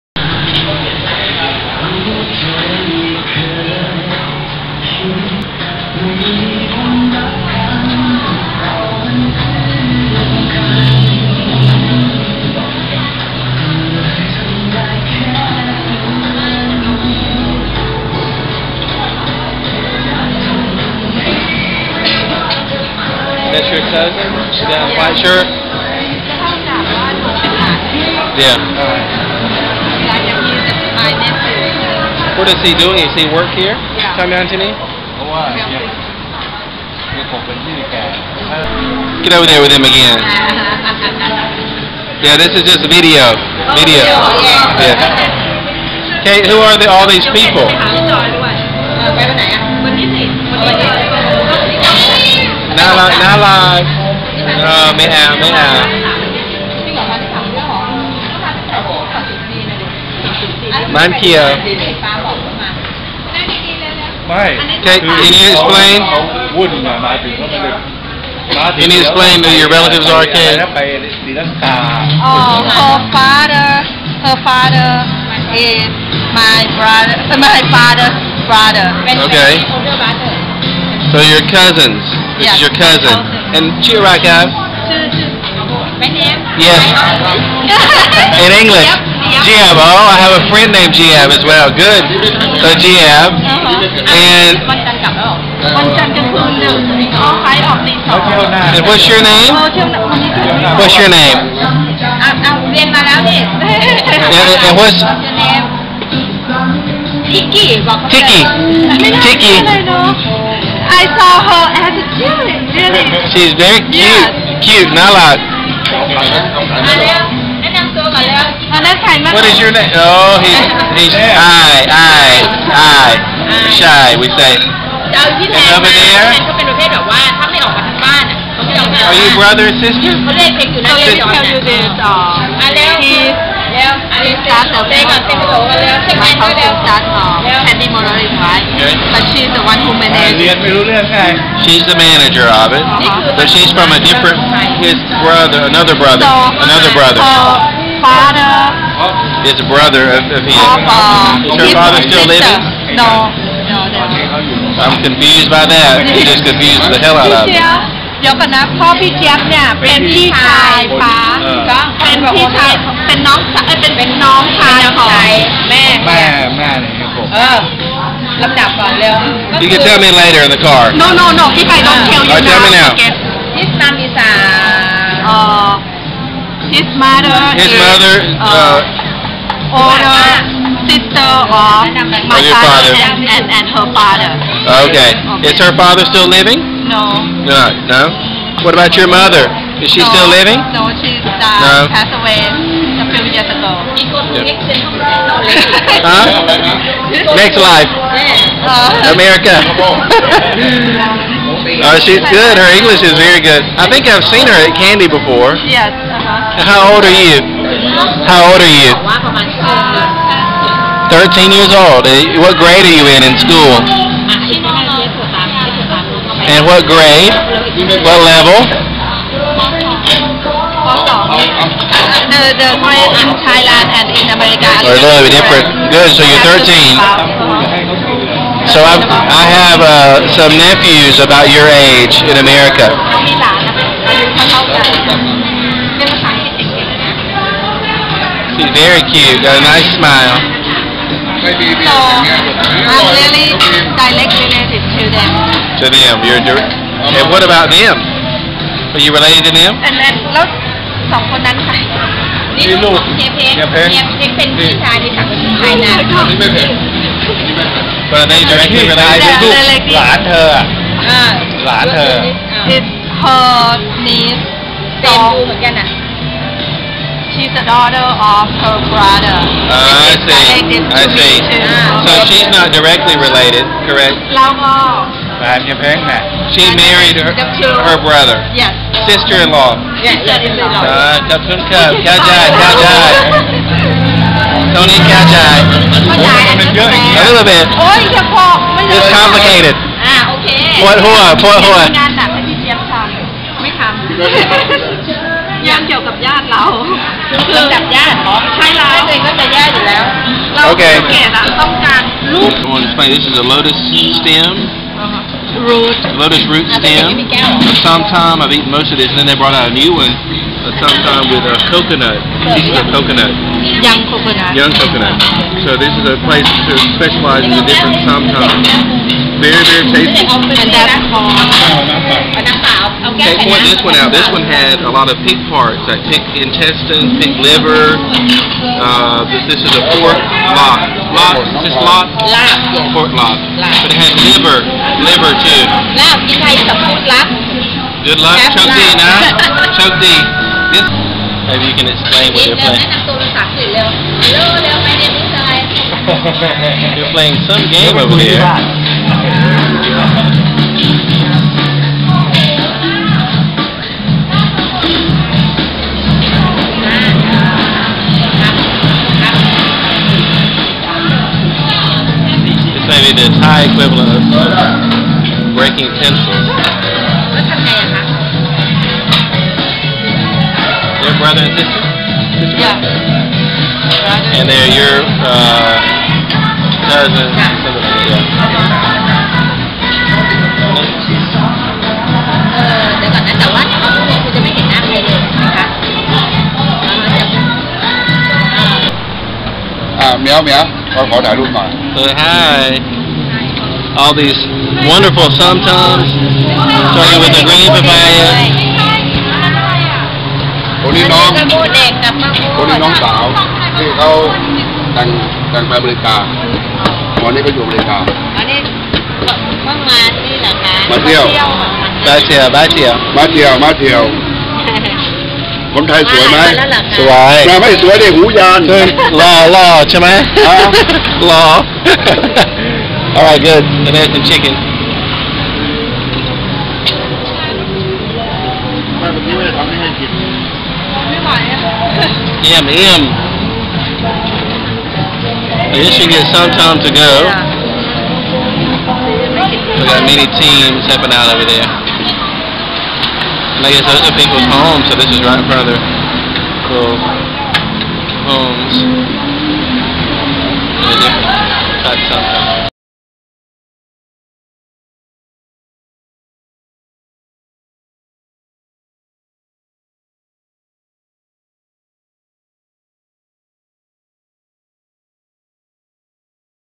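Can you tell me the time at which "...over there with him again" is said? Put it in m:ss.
0:39.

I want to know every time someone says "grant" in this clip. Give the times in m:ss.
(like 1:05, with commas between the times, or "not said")
3:42.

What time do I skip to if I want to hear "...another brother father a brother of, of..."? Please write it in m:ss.
2:26.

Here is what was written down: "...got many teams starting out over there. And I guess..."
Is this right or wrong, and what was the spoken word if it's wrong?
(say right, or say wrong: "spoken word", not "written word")
wrong: "stepping", not "starting".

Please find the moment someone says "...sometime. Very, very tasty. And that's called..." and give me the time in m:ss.
5:18.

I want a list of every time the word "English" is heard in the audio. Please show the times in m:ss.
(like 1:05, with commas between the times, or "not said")
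1:28, 3:22.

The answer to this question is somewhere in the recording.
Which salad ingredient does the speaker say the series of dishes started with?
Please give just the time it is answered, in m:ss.
6:37.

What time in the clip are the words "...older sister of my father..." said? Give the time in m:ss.
2:59.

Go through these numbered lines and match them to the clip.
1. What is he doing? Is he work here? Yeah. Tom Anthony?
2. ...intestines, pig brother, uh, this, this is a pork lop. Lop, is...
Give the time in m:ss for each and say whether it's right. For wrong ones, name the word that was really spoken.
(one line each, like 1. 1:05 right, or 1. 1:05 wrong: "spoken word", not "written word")
1. 0:32 right
2. 5:26 wrong: "liver", not "brother".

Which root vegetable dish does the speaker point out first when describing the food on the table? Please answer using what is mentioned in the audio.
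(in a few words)
lotus root stem.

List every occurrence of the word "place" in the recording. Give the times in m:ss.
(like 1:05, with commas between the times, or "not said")
5:16.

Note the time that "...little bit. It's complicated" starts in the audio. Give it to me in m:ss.
4:47.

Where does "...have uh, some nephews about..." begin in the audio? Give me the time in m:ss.
3:49.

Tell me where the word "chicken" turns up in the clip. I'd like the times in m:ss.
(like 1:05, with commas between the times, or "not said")
7:04.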